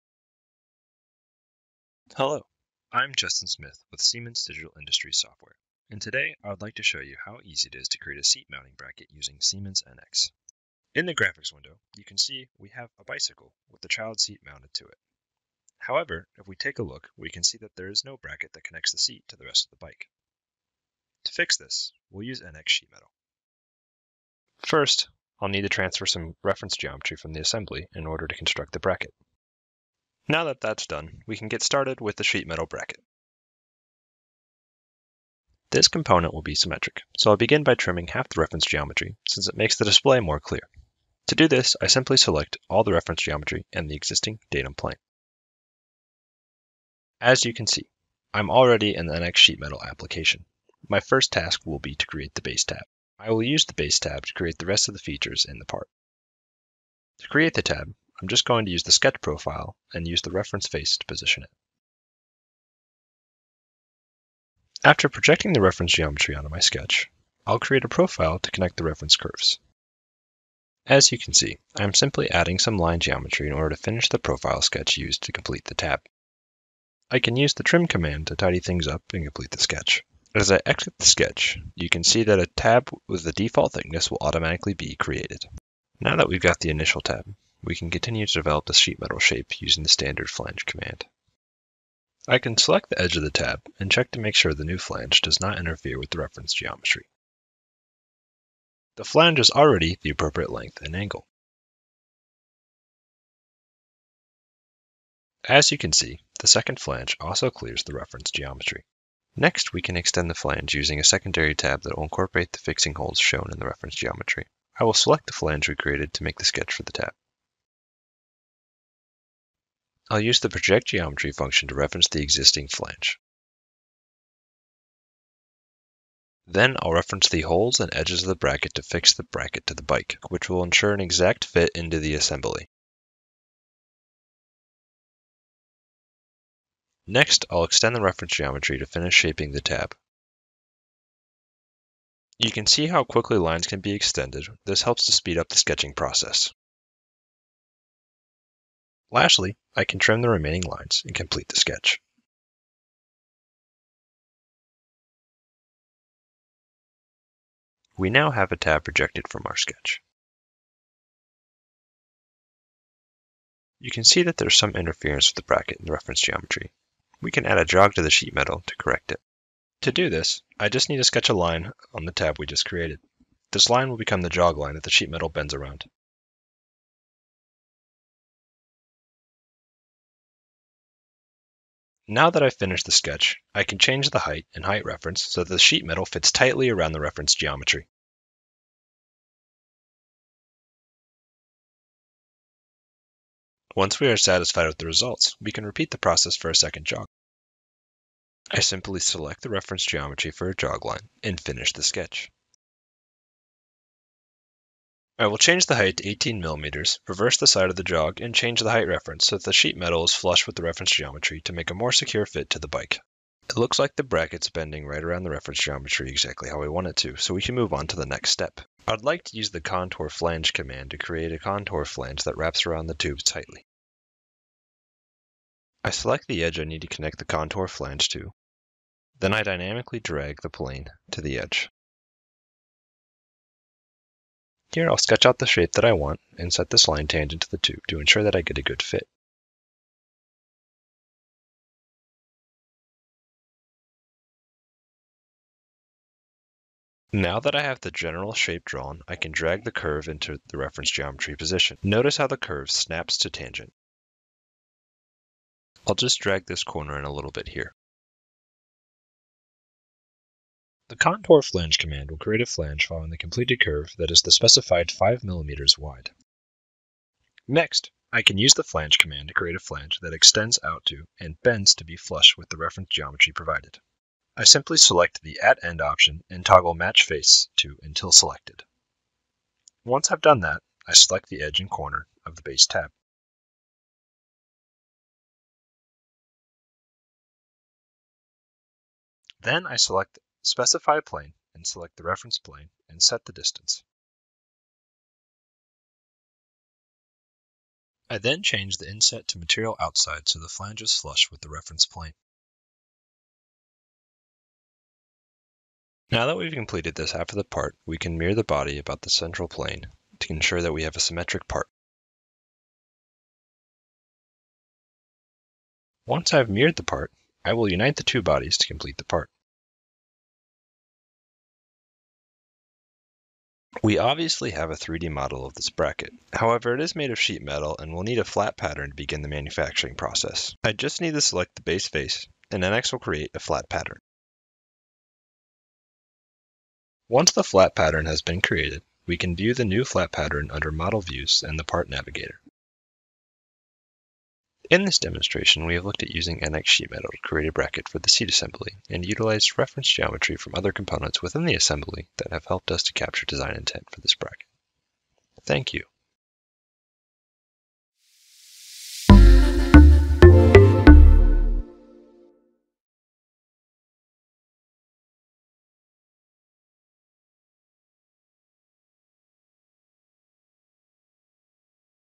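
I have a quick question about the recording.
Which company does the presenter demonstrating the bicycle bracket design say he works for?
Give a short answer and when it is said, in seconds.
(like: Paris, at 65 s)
Siemens Digital Industries Software, at 4 s.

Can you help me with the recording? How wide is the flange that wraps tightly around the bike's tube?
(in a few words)
5 mm.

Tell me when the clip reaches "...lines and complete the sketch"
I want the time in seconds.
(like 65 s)
150 s.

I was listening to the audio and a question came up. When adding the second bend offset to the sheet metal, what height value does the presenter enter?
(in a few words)
18 mm.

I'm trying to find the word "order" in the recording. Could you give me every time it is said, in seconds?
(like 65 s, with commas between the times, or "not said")
28 s, 73 s.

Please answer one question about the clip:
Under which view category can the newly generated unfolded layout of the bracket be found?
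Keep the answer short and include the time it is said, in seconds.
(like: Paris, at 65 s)
Model Views, at 340 s.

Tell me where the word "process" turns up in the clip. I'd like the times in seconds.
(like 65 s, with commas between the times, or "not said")
145 s, 195 s, 329 s.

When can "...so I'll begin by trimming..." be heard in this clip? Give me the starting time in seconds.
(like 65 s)
37 s.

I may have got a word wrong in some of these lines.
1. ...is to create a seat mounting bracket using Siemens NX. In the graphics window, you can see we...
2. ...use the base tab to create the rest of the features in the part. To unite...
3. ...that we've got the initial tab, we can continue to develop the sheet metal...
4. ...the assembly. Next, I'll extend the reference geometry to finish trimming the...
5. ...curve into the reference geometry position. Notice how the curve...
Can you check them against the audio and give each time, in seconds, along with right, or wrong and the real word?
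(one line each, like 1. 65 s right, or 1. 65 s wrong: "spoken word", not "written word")
1. 7 s right
2. 53 s wrong: "create", not "unite"
3. 86 s right
4. 131 s wrong: "shaping", not "trimming"
5. 249 s right.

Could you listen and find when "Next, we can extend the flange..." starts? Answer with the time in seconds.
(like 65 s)
109 s.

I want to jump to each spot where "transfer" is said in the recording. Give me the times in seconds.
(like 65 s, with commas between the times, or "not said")
25 s.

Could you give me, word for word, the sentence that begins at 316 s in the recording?
Once I've mirrored the part, I will unite the two bodies to complete the part.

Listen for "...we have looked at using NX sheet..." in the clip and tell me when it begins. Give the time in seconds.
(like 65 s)
345 s.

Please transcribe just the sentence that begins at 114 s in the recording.
I will select the flange we created to make the sketch for the tab.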